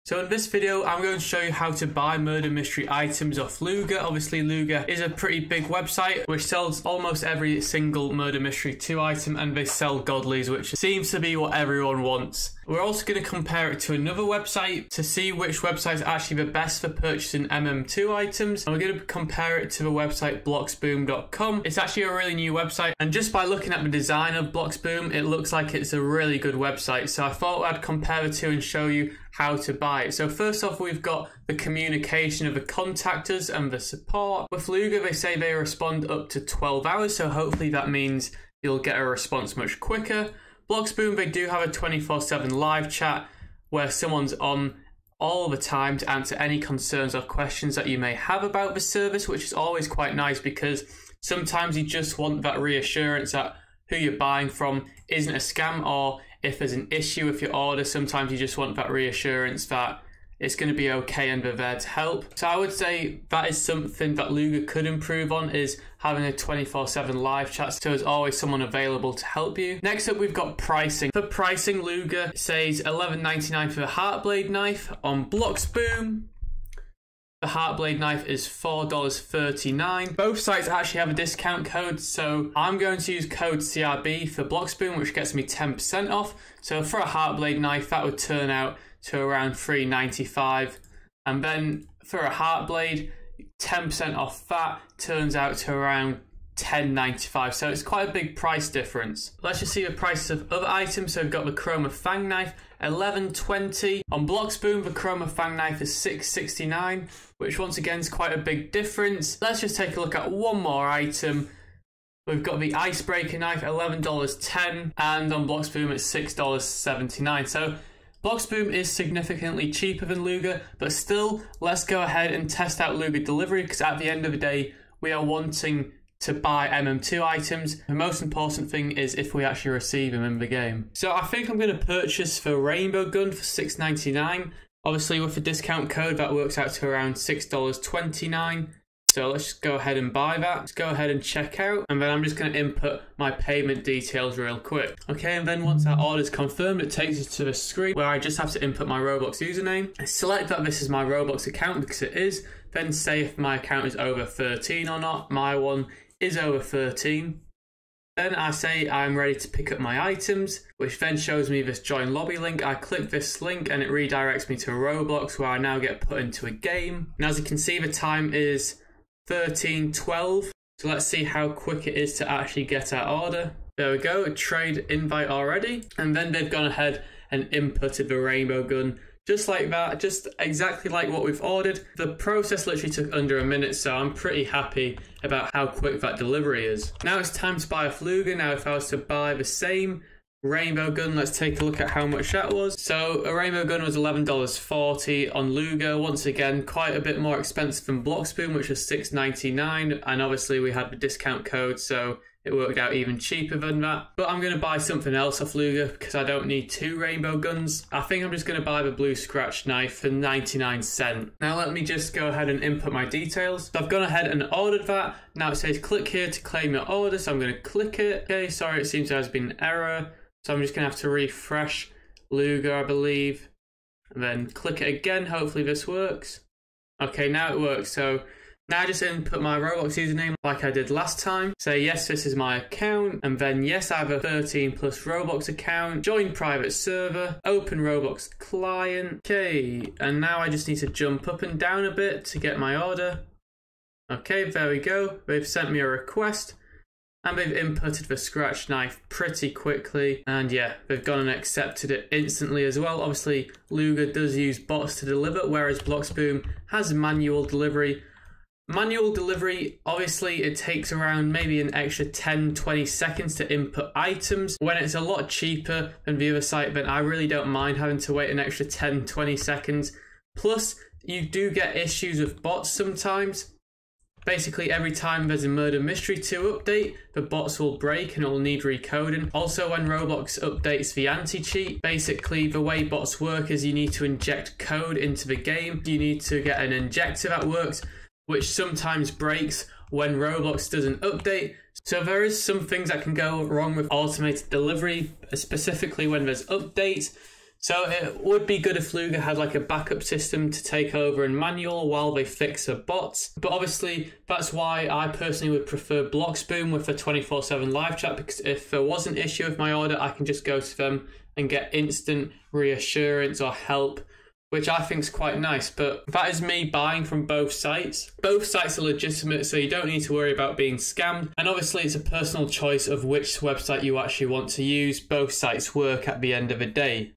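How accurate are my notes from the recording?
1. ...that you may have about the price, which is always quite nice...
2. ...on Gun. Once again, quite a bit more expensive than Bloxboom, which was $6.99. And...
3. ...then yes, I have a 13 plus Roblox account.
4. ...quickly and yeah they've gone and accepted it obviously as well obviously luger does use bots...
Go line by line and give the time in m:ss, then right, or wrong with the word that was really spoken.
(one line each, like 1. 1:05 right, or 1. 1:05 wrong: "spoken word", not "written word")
1. 0:47 wrong: "service", not "price"
2. 3:15 wrong: "Luger", not "Gun"
3. 3:53 right
4. 4:09 wrong: "instantly", not "obviously".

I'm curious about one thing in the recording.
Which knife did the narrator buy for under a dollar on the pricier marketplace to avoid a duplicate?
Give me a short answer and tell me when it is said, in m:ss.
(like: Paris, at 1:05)
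Blue Scratch knife, at 3:28.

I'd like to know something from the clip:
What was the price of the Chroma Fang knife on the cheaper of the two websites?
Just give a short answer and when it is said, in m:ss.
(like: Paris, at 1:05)
$6.69, at 1:45.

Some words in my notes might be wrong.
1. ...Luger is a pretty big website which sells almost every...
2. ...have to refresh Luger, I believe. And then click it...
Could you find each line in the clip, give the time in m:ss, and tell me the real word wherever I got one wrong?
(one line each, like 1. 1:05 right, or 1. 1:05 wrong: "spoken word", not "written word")
1. 0:04 right
2. 3:40 right.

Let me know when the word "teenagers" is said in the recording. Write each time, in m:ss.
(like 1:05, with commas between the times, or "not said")
not said.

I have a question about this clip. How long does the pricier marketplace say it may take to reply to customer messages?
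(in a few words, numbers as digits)
12 hours.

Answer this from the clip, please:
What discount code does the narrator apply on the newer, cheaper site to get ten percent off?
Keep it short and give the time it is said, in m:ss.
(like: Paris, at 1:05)
CRB, at 1:23.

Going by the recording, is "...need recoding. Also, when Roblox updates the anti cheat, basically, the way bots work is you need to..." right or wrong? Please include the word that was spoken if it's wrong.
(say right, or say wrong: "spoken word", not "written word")
right.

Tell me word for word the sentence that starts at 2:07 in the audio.
The most important thing is if we actually receive them in the game.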